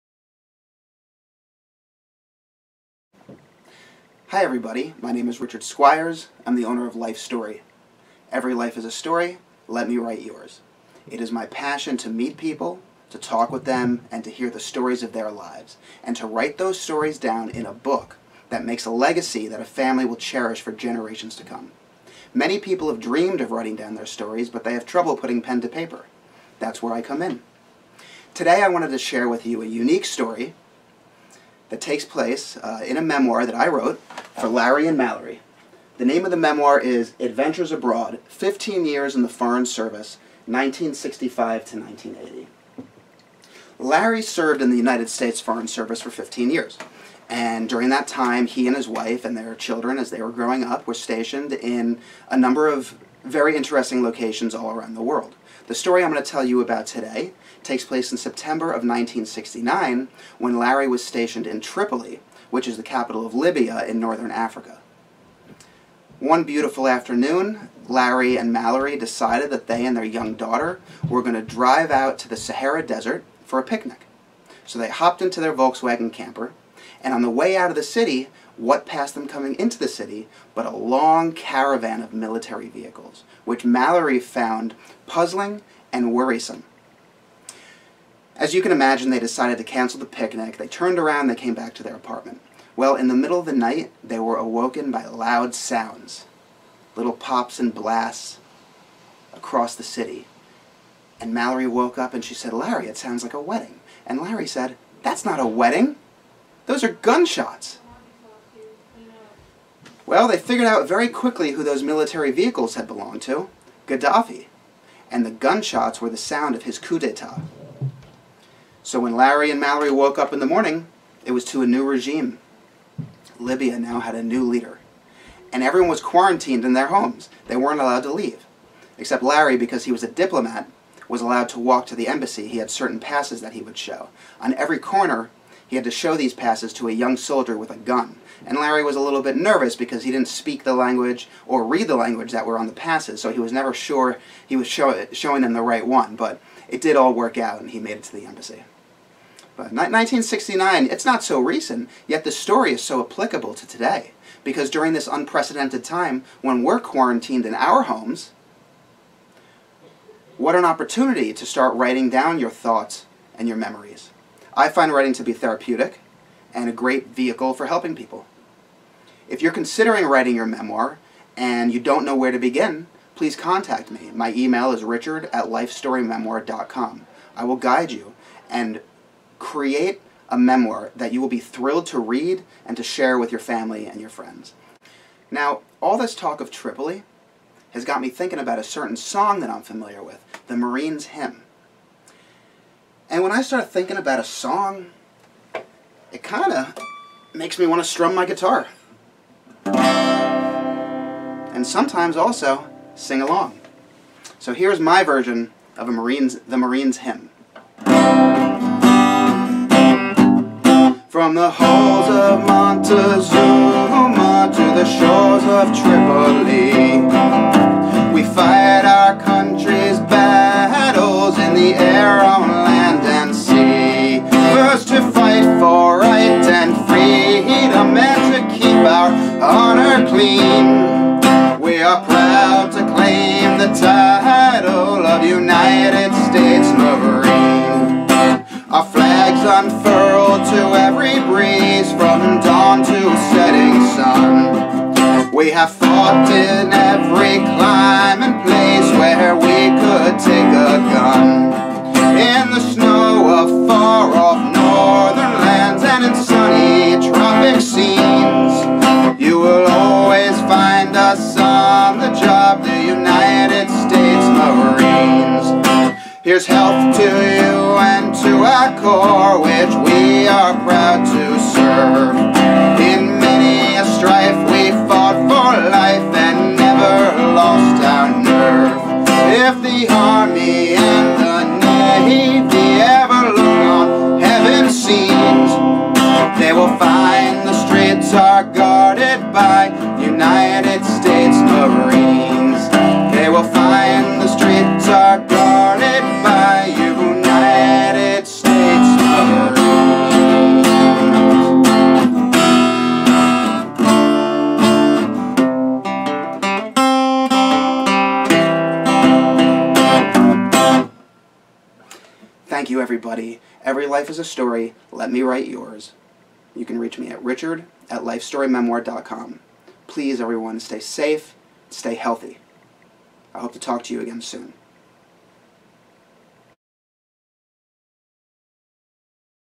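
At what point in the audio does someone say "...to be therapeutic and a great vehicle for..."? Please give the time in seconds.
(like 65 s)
165 s.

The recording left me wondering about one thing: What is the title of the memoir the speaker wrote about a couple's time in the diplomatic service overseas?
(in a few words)
Adventures Abroad.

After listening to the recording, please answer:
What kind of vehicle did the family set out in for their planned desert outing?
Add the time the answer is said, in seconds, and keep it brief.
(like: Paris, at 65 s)
Volkswagen camper, at 75 s.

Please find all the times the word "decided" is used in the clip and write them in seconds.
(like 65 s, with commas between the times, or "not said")
68 s, 89 s.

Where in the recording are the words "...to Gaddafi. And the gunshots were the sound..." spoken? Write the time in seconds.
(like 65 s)
113 s.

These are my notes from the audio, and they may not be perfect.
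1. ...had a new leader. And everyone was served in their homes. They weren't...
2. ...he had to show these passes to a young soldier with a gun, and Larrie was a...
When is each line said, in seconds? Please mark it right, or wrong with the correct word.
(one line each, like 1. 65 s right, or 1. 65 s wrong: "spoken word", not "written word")
1. 124 s wrong: "quarantined", not "served"
2. 135 s right.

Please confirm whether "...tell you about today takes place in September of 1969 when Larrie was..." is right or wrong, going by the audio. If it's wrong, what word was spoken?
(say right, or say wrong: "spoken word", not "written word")
right.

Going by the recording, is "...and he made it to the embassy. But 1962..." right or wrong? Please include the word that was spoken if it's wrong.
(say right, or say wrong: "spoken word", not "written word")
wrong: "1969", not "1962".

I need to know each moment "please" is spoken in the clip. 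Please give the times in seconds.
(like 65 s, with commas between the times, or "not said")
173 s, 319 s.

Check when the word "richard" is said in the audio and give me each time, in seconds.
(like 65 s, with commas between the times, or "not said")
5 s, 174 s, 317 s.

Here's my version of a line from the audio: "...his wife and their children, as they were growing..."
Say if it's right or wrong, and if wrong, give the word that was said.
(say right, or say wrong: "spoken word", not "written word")
right.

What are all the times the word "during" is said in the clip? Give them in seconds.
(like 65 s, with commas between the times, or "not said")
47 s, 154 s.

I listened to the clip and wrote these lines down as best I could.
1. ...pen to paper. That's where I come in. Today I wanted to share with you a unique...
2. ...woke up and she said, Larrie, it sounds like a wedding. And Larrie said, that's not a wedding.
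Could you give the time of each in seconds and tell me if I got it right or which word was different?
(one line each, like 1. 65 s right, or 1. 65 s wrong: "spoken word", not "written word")
1. 25 s right
2. 101 s right.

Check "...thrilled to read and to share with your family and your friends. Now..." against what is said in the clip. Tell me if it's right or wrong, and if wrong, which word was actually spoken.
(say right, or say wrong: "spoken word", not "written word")
right.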